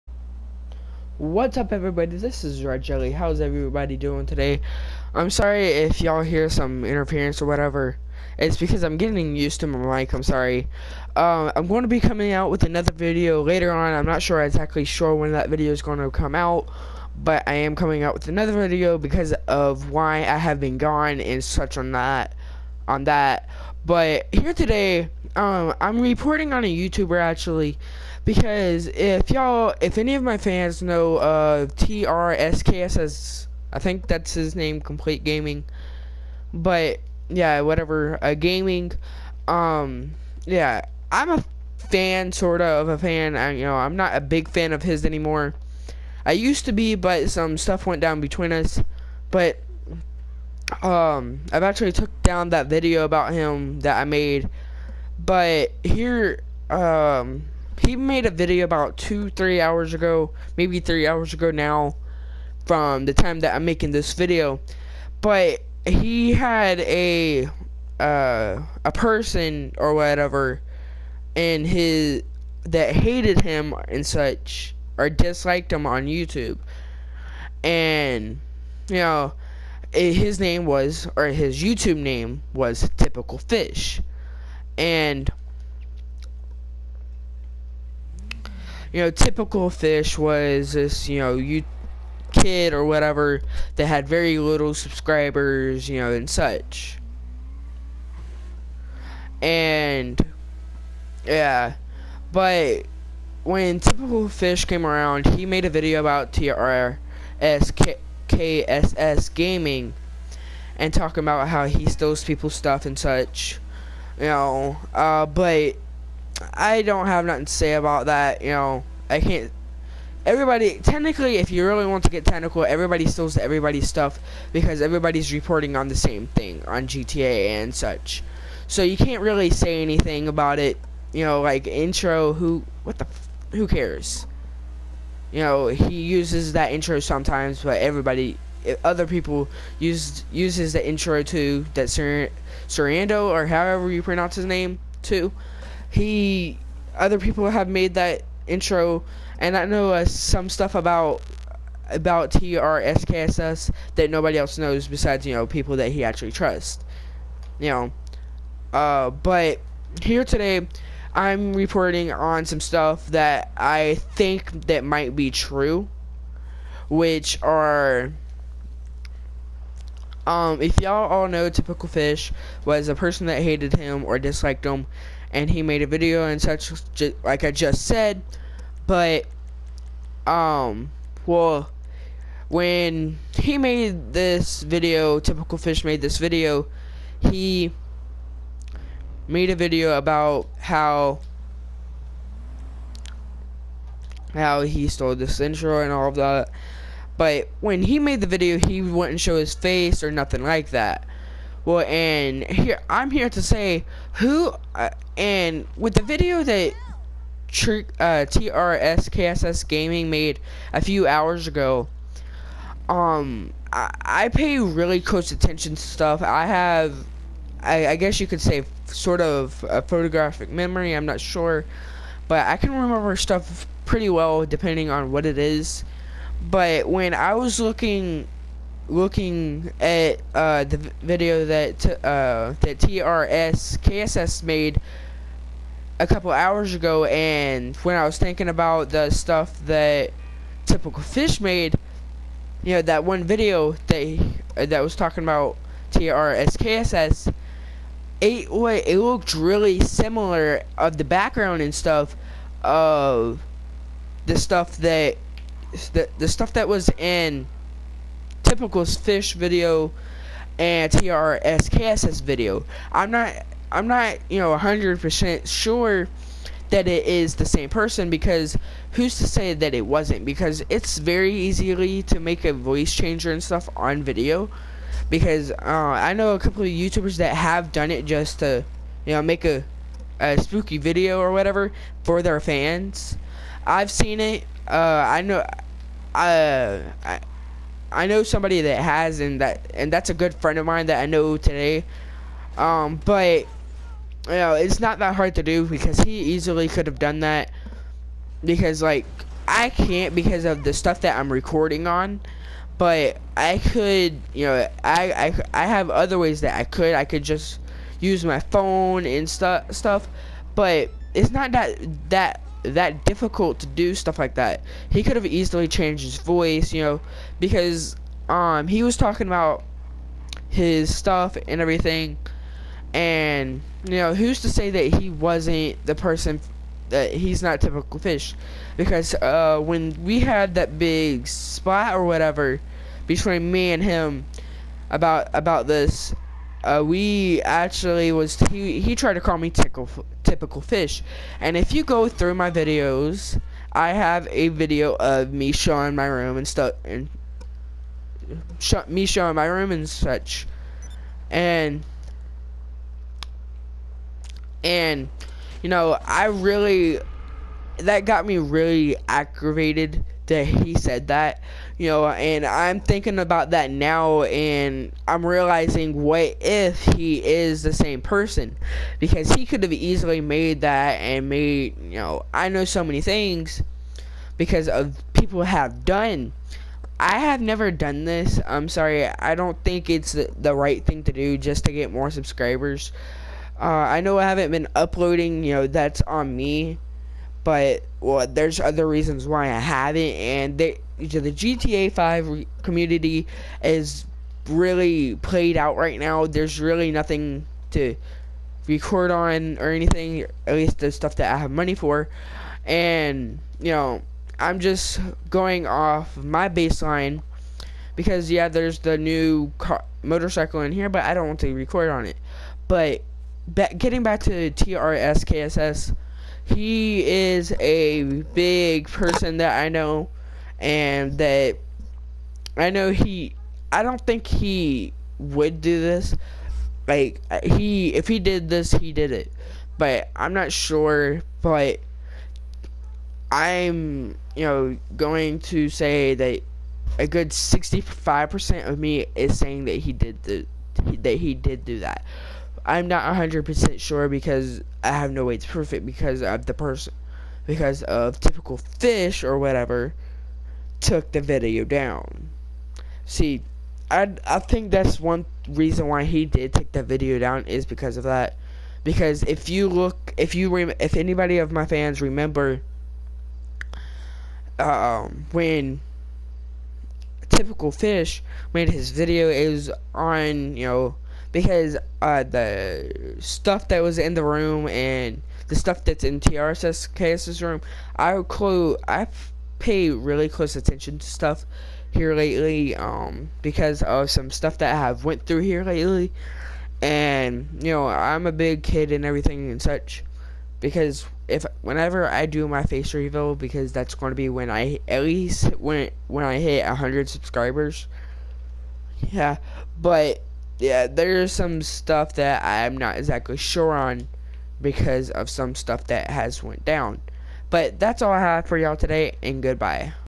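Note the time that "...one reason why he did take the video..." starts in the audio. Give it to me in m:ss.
7:34.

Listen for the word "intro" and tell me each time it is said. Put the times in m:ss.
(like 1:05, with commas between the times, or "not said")
2:11, 2:16, 2:20, 2:28, 3:15.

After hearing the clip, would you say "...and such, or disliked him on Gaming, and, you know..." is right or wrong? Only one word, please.
wrong.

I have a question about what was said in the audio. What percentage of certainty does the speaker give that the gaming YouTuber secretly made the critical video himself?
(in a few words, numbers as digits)
65%.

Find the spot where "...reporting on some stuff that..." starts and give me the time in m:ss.
2:41.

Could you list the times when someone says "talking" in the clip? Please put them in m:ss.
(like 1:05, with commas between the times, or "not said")
1:50, 4:04, 5:18.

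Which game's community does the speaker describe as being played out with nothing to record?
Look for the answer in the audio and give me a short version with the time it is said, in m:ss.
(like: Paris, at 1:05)
GTA 5, at 6:31.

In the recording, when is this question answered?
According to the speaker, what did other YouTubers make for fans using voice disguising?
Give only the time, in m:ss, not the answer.
4:40.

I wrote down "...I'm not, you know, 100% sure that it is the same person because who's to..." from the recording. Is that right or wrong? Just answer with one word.
right.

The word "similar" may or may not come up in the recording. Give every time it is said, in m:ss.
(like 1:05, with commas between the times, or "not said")
4:09.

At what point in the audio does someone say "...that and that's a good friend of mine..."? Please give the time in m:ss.
4:49.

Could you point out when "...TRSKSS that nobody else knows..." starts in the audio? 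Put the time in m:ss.
2:32.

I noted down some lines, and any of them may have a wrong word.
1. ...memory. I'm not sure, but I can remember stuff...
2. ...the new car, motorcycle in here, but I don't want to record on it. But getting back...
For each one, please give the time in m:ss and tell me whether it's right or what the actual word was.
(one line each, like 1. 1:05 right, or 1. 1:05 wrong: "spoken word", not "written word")
1. 3:40 right
2. 6:48 right.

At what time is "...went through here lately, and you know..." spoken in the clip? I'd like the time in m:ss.
8:05.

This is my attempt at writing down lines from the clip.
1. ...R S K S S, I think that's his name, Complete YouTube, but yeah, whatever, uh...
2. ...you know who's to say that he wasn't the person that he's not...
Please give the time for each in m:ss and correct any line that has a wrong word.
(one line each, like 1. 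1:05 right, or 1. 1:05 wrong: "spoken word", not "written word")
1. 0:32 wrong: "Gaming", not "YouTube"
2. 5:23 right.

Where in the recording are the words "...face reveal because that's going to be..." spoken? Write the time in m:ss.
8:12.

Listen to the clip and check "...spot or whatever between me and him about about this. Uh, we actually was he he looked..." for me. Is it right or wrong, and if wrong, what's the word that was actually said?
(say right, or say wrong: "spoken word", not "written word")
wrong: "tried", not "looked".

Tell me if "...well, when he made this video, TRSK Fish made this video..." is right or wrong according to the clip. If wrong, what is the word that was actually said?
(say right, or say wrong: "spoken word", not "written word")
wrong: "Typical", not "TRSK".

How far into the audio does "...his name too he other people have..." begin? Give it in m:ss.
2:24.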